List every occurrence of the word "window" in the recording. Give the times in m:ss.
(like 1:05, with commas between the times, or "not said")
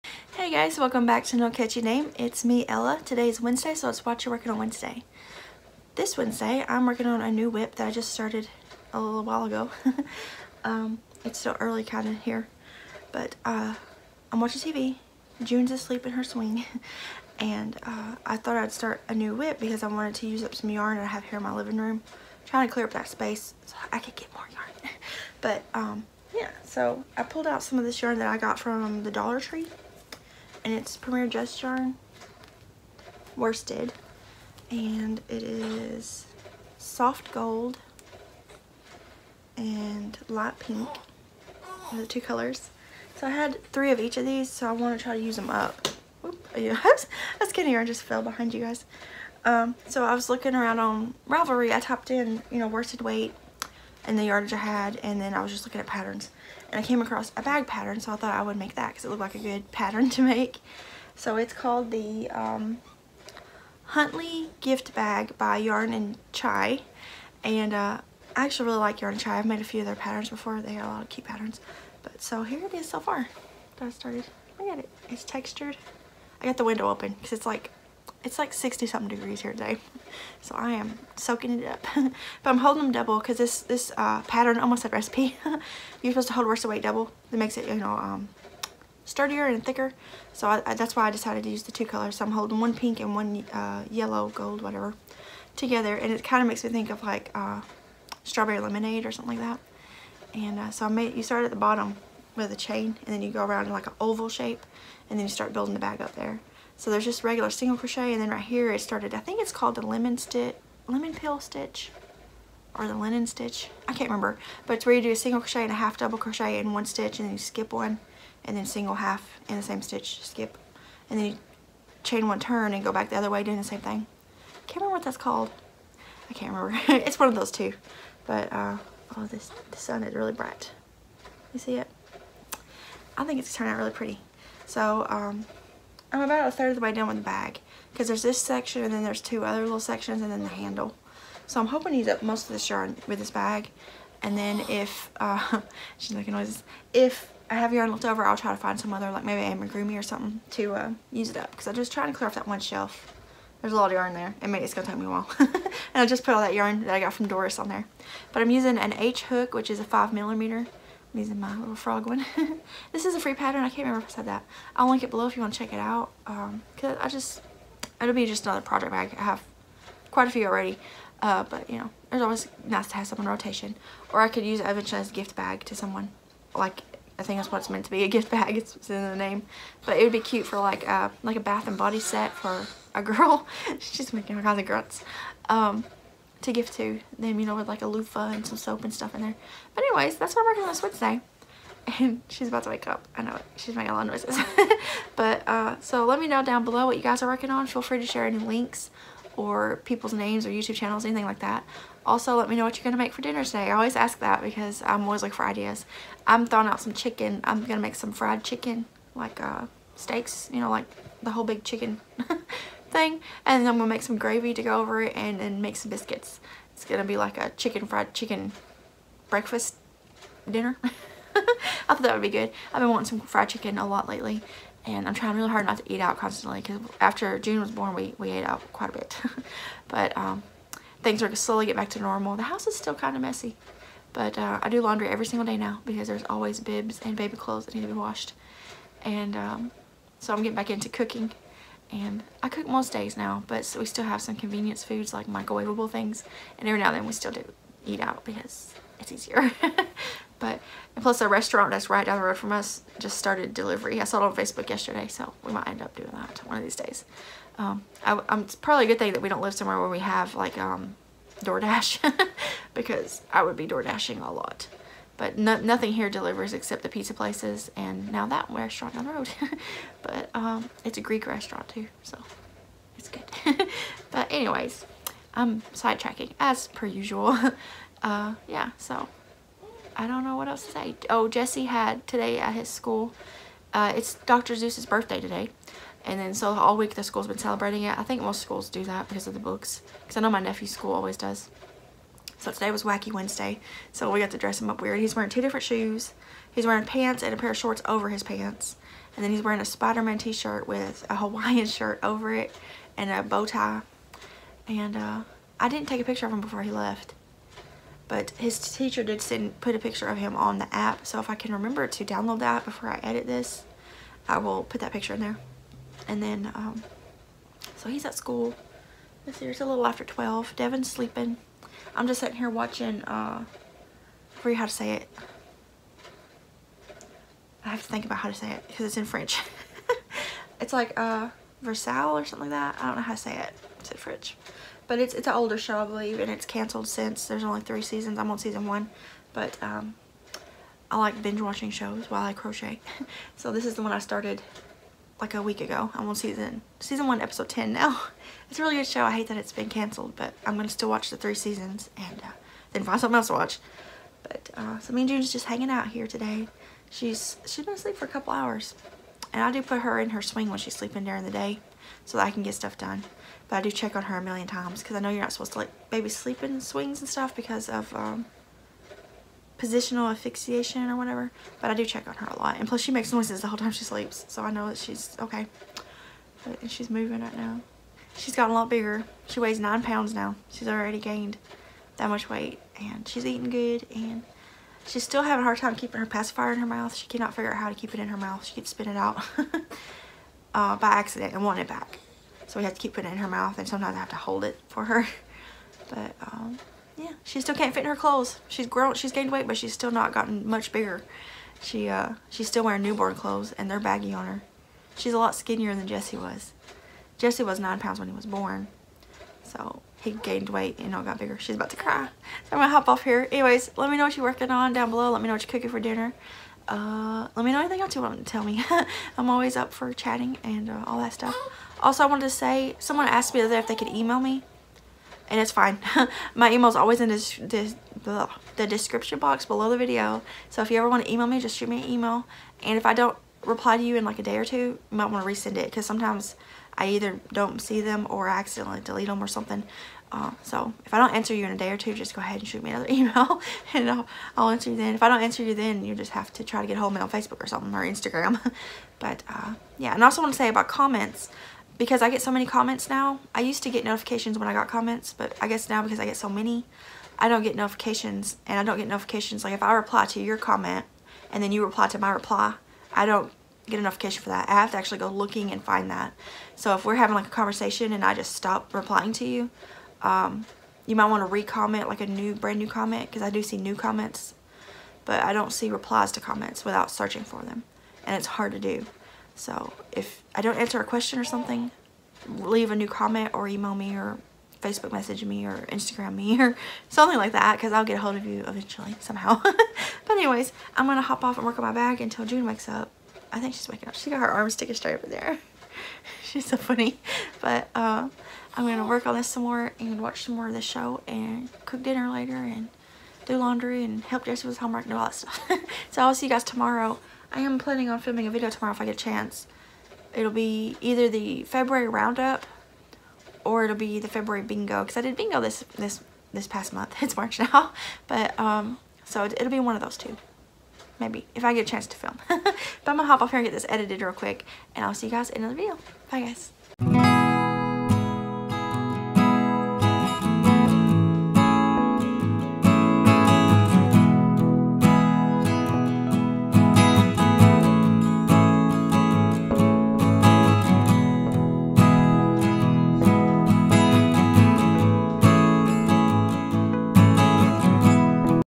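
1:16.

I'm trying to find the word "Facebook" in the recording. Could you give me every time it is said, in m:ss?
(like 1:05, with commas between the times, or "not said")
4:14, 7:27, 8:04.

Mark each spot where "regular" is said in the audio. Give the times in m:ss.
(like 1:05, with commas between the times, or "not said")
1:47.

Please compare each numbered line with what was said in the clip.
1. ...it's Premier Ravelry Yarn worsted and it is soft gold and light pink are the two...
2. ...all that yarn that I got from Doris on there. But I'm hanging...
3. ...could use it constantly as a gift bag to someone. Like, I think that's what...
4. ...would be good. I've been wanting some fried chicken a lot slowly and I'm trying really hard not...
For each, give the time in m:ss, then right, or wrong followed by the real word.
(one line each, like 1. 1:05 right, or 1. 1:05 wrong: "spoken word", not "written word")
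1. 0:30 wrong: "Just", not "Ravelry"
2. 2:36 wrong: "using", not "hanging"
3. 2:54 wrong: "eventually", not "constantly"
4. 3:42 wrong: "lately", not "slowly".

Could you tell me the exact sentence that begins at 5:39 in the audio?
But um, I like binge watching shows while I crochet.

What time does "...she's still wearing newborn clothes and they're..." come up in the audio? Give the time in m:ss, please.
6:42.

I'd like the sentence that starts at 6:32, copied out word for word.
So we have to keep putting it in her mouth.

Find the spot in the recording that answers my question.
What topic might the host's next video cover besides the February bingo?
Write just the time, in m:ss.
8:31.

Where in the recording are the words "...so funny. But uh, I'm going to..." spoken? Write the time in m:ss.
8:16.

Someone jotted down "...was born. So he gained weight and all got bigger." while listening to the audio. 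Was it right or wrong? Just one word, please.
right.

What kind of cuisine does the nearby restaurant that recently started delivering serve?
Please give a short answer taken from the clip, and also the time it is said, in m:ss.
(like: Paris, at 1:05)
Greek, at 4:31.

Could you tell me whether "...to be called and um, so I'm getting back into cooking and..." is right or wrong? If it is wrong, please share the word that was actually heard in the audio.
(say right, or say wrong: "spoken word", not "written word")
wrong: "washed", not "called".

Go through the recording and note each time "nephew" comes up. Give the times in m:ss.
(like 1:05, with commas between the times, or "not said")
4:50.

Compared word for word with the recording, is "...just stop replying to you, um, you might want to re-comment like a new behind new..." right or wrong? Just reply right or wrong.
wrong.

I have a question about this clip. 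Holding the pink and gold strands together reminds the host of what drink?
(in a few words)
strawberry lemonade.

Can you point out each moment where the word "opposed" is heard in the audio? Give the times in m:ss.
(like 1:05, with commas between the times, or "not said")
not said.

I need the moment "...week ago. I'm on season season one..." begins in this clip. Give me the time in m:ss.
5:45.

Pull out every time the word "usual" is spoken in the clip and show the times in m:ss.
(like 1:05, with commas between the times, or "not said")
4:36.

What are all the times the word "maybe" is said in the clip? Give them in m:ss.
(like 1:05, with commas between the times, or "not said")
2:29, 8:40.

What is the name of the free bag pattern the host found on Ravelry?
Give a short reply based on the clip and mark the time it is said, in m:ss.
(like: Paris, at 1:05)
Huntley gift bag, at 1:03.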